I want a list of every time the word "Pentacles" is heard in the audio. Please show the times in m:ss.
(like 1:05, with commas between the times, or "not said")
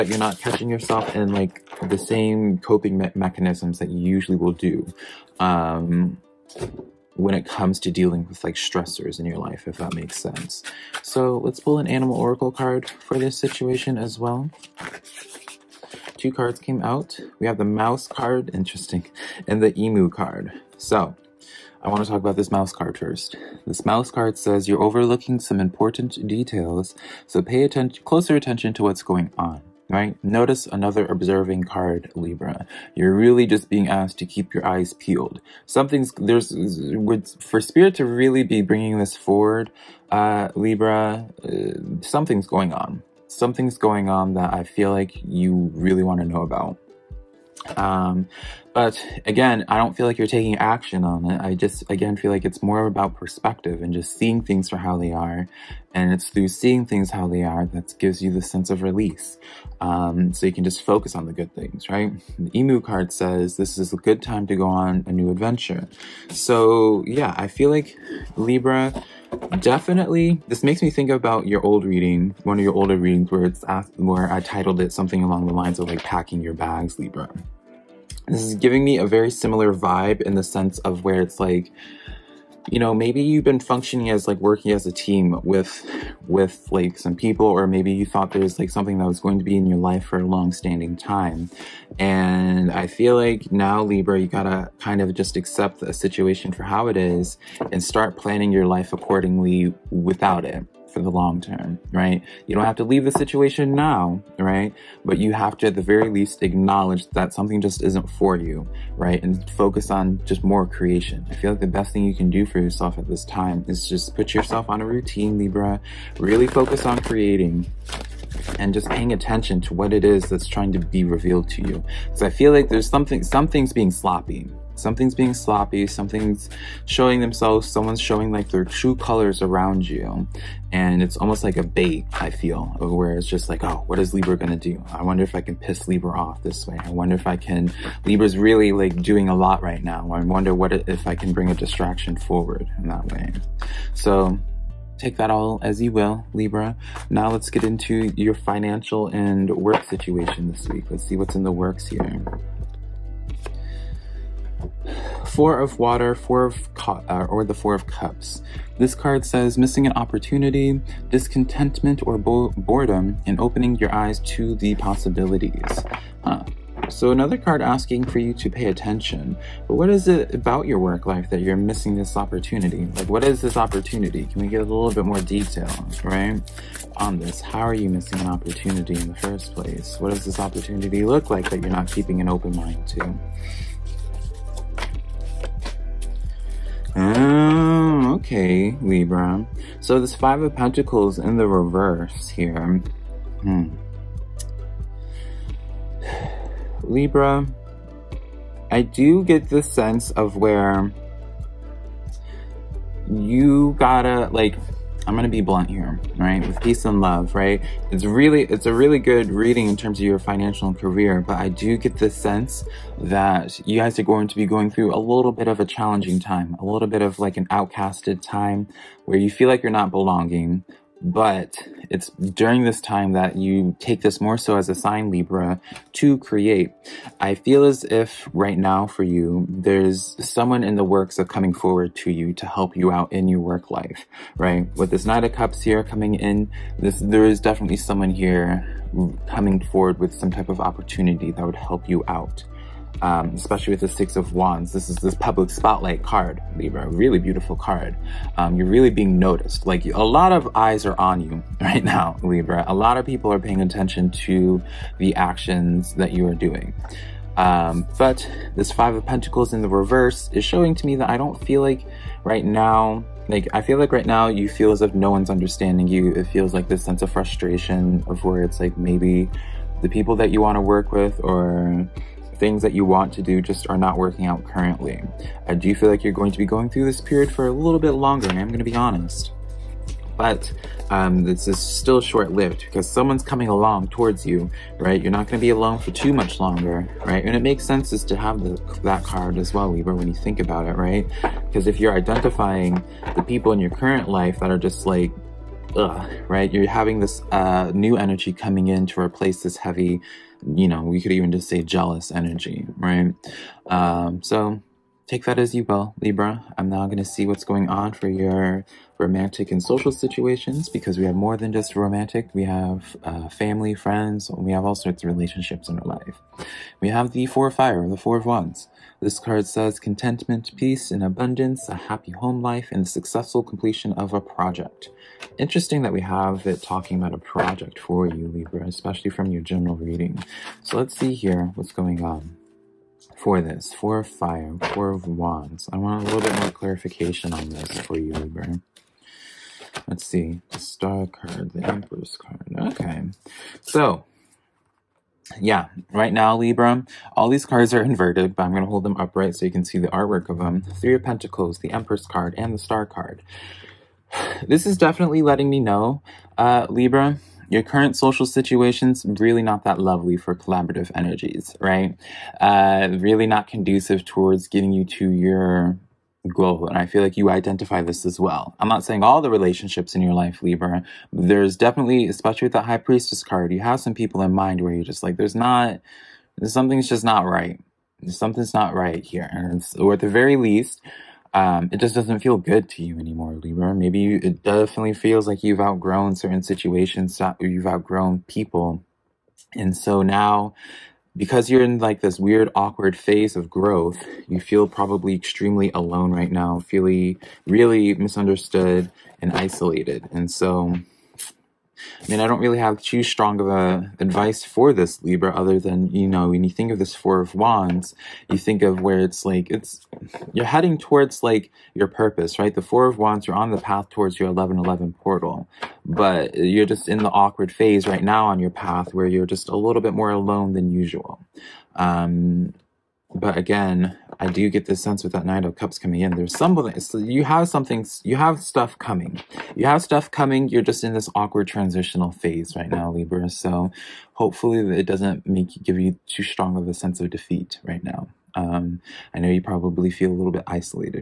3:10, 4:19, 5:51.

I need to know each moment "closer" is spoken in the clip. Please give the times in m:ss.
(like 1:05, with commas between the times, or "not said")
0:28.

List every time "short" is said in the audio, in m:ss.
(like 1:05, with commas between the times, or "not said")
4:42.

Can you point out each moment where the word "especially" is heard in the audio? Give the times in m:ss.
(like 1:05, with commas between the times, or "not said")
4:03, 5:28, 6:12.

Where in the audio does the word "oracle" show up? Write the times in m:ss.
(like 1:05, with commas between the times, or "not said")
0:12.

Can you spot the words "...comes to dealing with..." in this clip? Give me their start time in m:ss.
0:07.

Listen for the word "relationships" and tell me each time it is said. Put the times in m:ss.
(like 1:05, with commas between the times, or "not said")
5:15, 6:09.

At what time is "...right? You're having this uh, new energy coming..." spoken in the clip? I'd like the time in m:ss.
4:56.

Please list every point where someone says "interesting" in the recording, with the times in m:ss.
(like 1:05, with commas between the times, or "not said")
0:18, 5:25.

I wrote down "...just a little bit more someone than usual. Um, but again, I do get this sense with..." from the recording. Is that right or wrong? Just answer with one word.
wrong.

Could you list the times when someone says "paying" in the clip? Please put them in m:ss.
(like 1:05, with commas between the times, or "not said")
1:58, 4:13.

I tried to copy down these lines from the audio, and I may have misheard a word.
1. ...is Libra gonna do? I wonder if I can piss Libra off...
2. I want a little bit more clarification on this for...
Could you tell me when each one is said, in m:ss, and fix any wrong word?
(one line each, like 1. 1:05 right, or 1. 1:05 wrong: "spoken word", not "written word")
1. 2:13 right
2. 5:35 right.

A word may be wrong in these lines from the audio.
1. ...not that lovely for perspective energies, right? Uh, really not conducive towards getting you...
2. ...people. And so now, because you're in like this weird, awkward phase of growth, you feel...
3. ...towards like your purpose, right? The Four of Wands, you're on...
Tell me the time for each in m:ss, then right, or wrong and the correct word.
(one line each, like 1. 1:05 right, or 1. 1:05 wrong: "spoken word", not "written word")
1. 5:59 wrong: "collaborative", not "perspective"
2. 6:28 right
3. 6:50 right.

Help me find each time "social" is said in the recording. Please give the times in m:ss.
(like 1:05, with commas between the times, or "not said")
5:09, 5:57.